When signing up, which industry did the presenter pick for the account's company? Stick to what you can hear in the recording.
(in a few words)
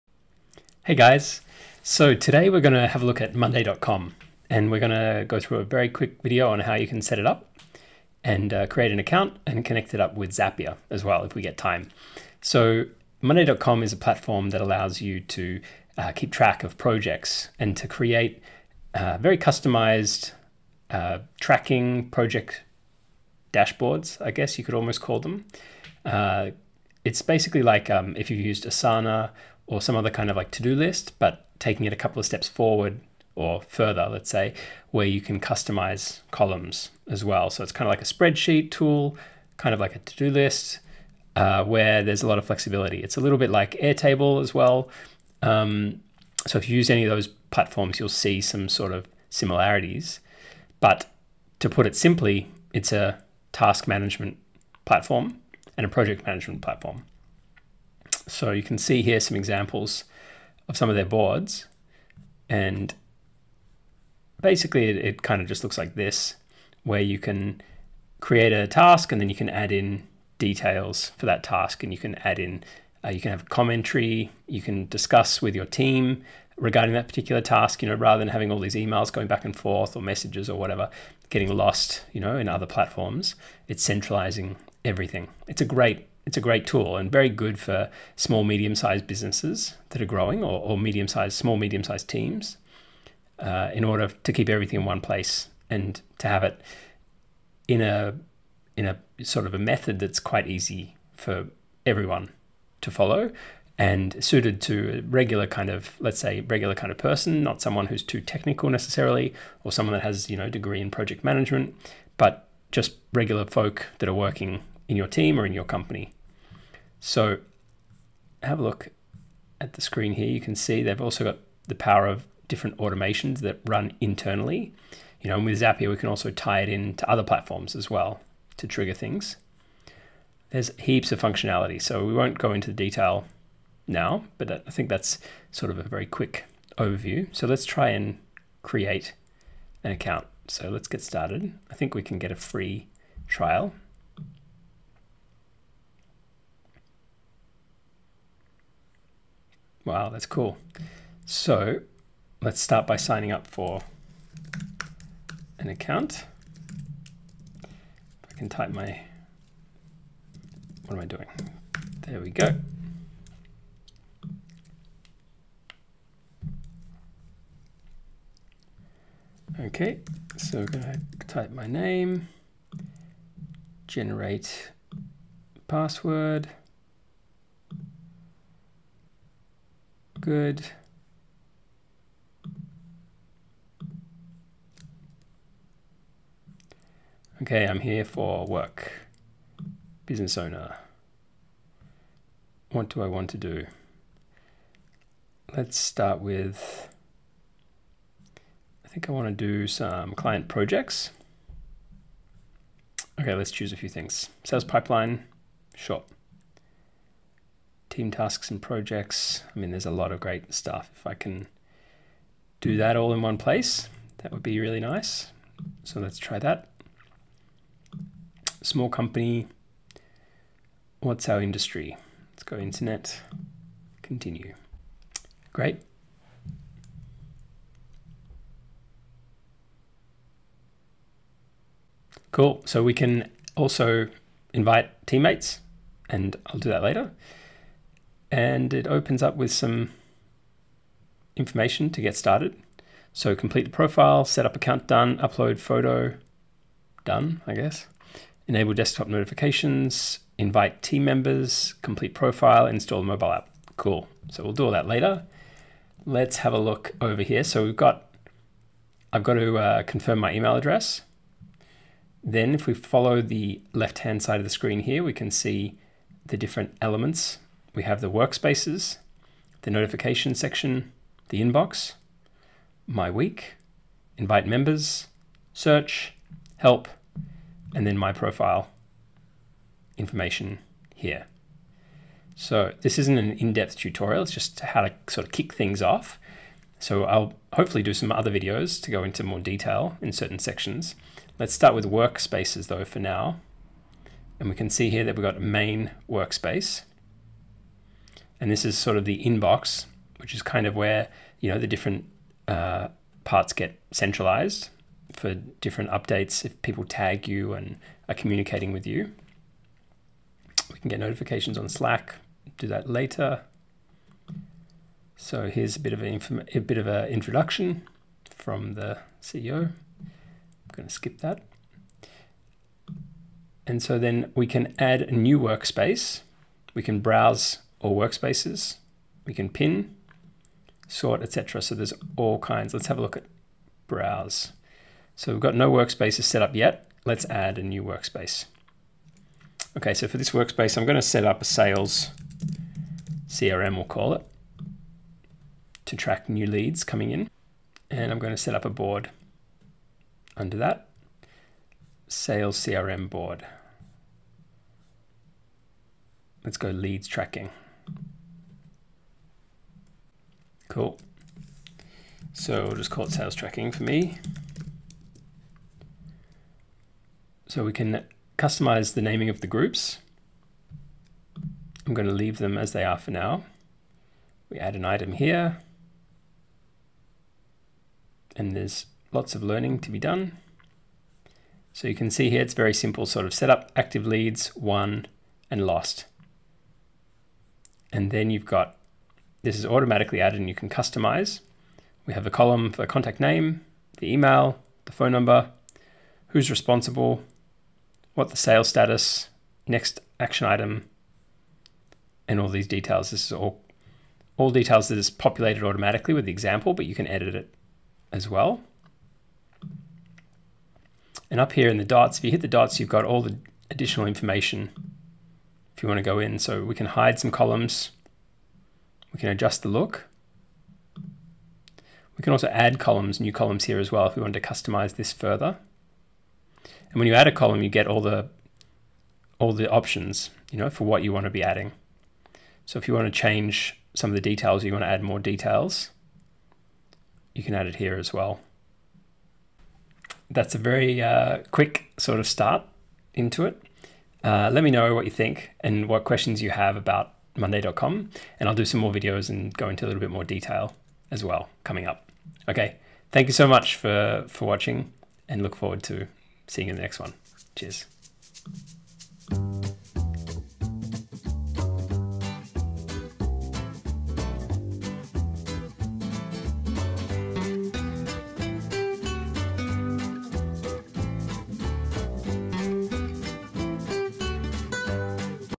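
Internet.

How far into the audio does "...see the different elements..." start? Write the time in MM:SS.
04:25.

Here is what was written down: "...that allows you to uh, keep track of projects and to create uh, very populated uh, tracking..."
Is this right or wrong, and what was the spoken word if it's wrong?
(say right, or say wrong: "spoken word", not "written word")
wrong: "customized", not "populated".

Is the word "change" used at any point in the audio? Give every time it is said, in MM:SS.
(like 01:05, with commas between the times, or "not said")
07:13.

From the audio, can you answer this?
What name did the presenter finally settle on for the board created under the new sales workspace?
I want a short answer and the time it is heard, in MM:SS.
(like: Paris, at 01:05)
Sales tracking, at 06:03.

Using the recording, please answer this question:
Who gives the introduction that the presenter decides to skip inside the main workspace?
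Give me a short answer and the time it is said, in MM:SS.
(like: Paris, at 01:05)
The CEO, at 05:18.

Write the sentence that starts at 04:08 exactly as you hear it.
Enable desktop notifications, invite team members, complete profile, install mobile app.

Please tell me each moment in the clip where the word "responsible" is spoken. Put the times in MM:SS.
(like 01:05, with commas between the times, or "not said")
06:36.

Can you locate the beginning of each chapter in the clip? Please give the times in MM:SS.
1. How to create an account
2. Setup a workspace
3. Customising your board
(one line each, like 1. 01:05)
1. 02:17
2. 05:22
3. 06:00.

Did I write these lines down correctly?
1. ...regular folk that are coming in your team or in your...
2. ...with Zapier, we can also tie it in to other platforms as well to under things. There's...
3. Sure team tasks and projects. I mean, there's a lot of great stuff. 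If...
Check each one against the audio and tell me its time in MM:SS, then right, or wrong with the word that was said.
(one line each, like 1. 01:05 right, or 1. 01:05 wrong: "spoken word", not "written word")
1. 01:53 wrong: "working", not "coming"
2. 02:05 wrong: "trigger", not "under"
3. 03:26 right.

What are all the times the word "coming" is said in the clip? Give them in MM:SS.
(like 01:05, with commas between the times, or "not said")
05:46, 07:31.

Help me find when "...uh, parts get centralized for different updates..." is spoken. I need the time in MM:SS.
05:02.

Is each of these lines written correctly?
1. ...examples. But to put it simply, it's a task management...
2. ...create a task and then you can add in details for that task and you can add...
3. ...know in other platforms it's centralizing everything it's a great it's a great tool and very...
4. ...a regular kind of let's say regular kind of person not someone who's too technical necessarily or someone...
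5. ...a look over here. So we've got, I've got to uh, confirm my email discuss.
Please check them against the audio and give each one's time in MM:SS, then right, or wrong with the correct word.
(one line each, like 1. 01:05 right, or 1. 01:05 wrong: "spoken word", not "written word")
1. 00:49 wrong: "similarities", not "examples"
2. 01:08 right
3. 01:22 right
4. 01:44 right
5. 04:16 wrong: "address", not "discuss".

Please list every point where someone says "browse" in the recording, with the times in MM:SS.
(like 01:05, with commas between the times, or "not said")
05:27, 05:33.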